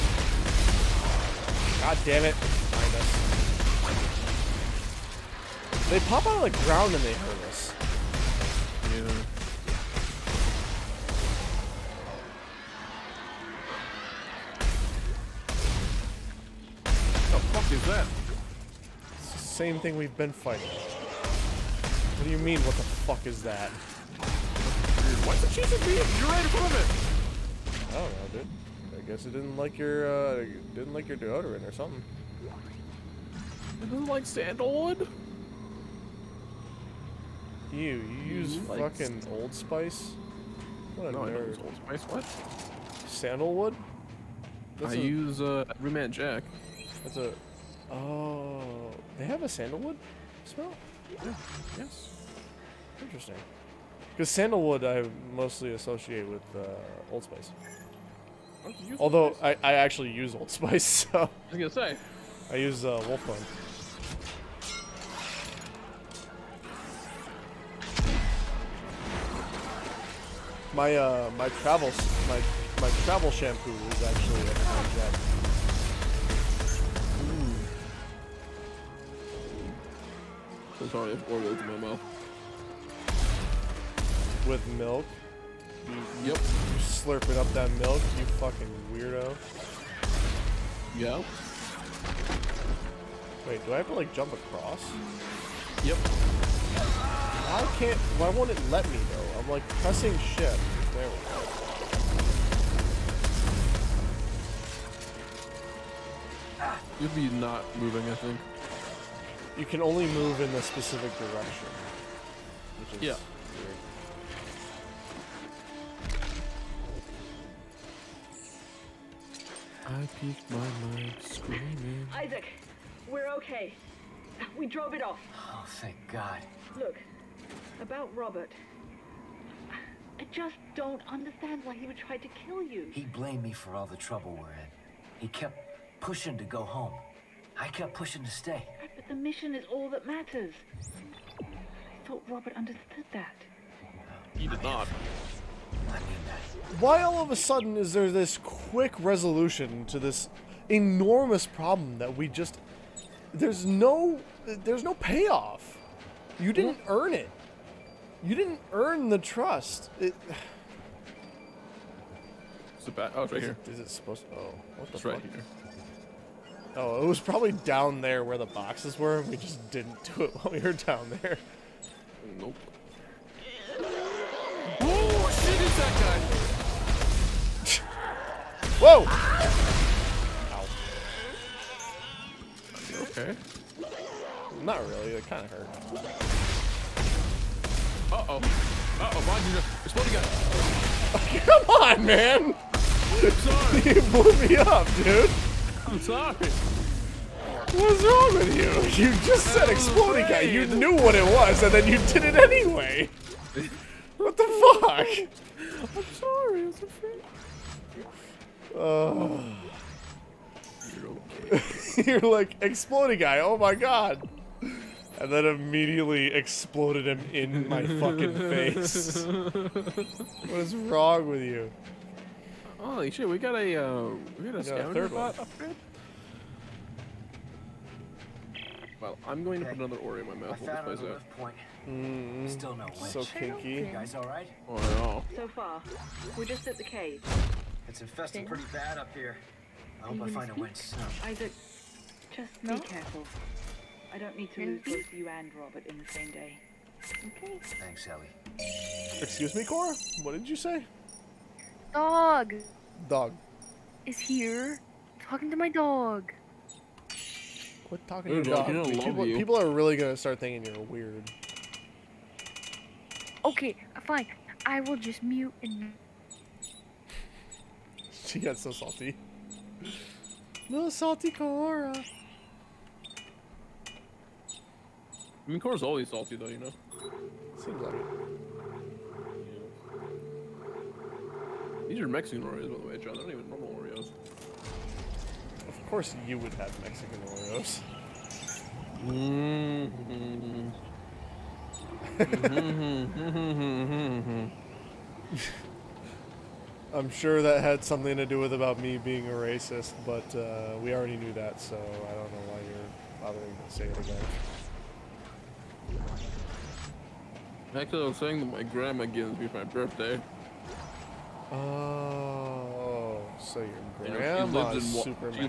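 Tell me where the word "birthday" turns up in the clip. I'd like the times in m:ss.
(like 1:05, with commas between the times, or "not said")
5:09.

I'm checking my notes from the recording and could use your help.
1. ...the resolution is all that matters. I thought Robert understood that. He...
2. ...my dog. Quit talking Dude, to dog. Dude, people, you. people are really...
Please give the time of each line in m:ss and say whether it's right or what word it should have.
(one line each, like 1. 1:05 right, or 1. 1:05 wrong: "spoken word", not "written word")
1. 2:19 wrong: "mission", not "resolution"
2. 4:15 right.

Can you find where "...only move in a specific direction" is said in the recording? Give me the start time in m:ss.
1:49.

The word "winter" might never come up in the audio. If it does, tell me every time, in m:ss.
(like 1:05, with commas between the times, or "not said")
not said.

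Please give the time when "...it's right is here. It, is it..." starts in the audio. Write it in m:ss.
2:43.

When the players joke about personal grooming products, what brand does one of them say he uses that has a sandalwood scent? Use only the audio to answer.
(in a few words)
Roommate Jack.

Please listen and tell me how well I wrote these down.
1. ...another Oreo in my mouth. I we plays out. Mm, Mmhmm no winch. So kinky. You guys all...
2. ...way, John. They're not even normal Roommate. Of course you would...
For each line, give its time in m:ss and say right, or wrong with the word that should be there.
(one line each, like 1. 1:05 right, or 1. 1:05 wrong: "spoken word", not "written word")
1. 3:49 wrong: "Still", not "Mmhmm"
2. 4:42 wrong: "Oreos", not "Roommate".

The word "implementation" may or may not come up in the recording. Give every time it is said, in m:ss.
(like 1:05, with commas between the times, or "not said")
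not said.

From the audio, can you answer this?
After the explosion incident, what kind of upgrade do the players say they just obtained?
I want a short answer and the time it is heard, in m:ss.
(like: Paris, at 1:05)
scavenger bot upgrade, at 3:44.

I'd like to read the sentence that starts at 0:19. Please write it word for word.
It's the same thing we've been fighting.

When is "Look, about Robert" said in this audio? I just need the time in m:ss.
2:06.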